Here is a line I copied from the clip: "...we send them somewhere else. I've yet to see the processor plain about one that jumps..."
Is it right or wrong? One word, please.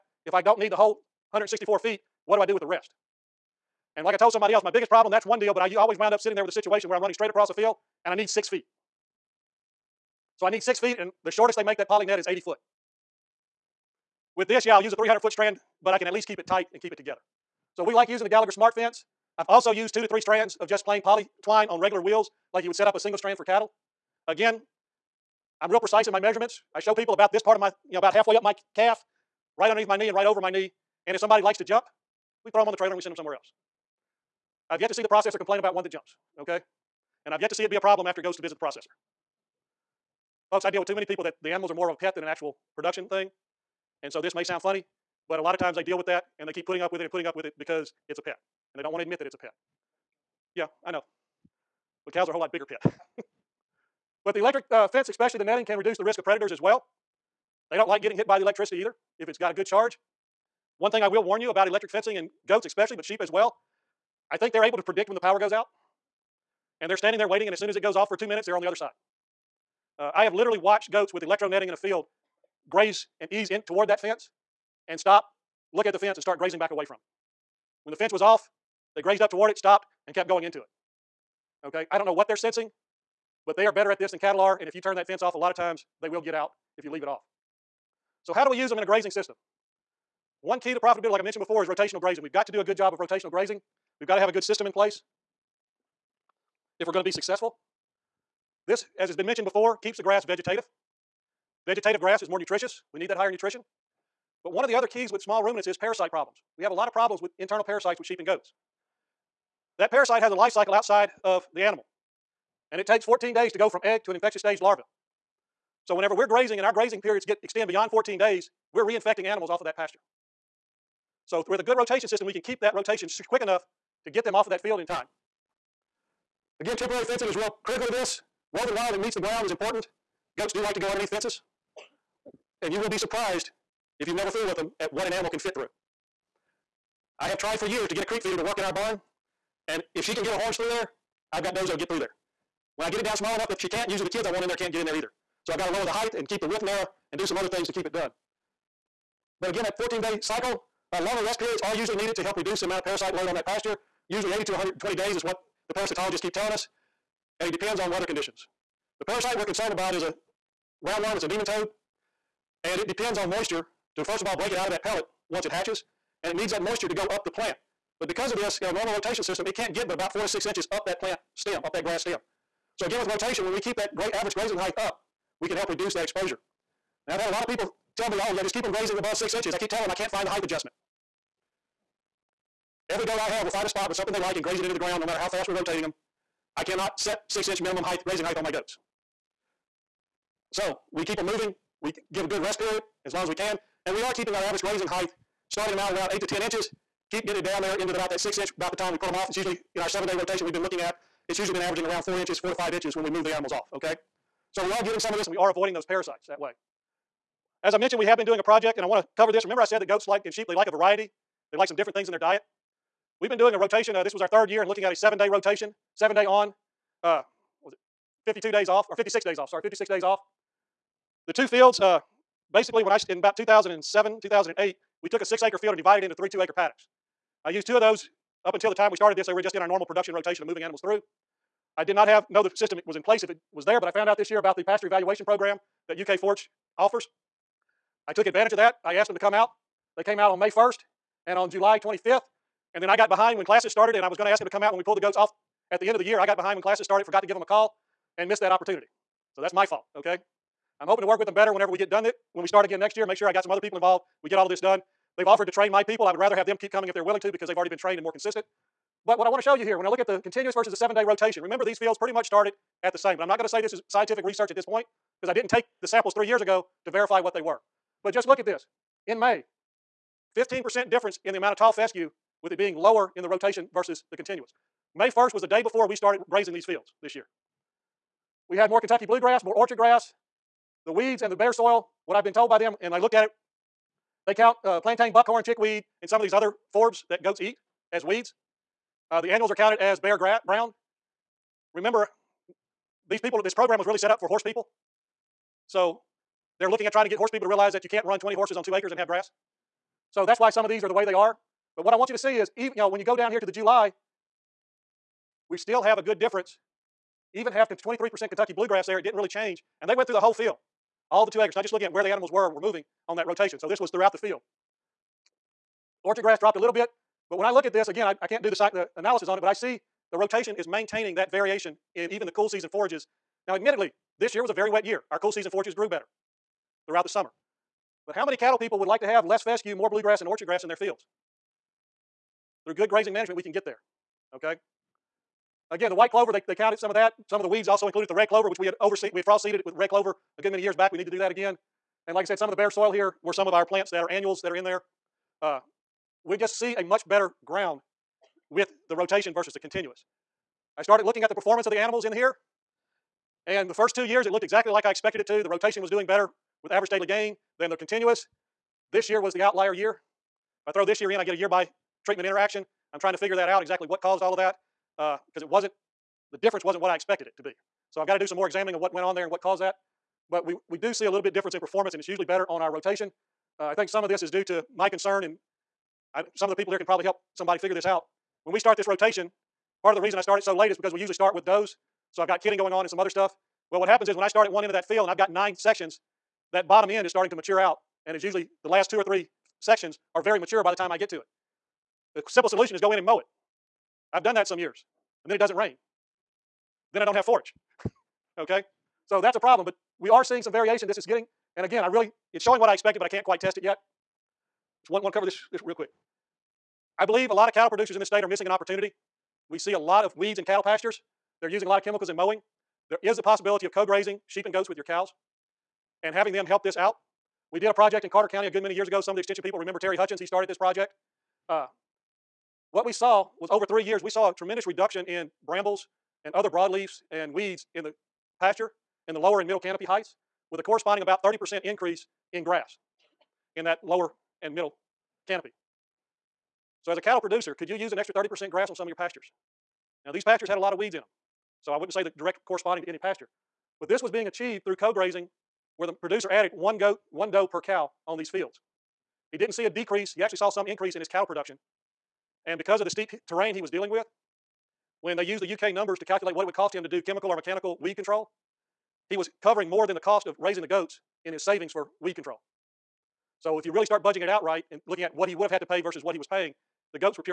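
wrong.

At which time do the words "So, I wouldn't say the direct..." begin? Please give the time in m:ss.
7:21.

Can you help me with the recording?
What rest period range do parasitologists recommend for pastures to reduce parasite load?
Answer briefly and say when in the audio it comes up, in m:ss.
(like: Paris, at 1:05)
80 to 120 days, at 2:34.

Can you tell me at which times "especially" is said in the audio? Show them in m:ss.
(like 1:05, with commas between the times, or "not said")
0:55, 1:02.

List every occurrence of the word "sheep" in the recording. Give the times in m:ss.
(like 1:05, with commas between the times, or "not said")
1:03, 1:48, 3:30, 6:54.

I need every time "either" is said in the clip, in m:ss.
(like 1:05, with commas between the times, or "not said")
0:58, 2:24.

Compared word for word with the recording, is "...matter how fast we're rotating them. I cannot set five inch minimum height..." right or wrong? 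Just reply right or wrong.
wrong.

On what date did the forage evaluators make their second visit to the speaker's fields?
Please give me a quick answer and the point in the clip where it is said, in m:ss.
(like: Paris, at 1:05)
July 25th, at 4:01.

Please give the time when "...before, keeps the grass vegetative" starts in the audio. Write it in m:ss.
1:39.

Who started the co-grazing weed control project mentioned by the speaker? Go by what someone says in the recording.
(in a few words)
Terry Hutchins.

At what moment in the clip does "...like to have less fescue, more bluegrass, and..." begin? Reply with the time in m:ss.
5:28.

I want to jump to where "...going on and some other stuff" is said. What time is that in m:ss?
6:22.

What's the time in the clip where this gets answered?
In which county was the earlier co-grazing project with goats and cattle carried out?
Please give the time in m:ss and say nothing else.
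6:58.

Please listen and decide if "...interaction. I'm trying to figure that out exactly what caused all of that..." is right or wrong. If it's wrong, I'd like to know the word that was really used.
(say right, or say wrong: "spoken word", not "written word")
right.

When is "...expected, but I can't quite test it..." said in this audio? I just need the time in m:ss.
6:42.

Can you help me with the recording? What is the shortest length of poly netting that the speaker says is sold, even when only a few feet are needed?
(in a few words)
80 foot.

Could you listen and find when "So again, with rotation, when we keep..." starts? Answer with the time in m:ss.
2:52.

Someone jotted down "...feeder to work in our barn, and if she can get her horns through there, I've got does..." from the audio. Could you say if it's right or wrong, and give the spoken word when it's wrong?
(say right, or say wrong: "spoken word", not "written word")
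right.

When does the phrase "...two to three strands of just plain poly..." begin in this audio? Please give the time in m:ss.
0:19.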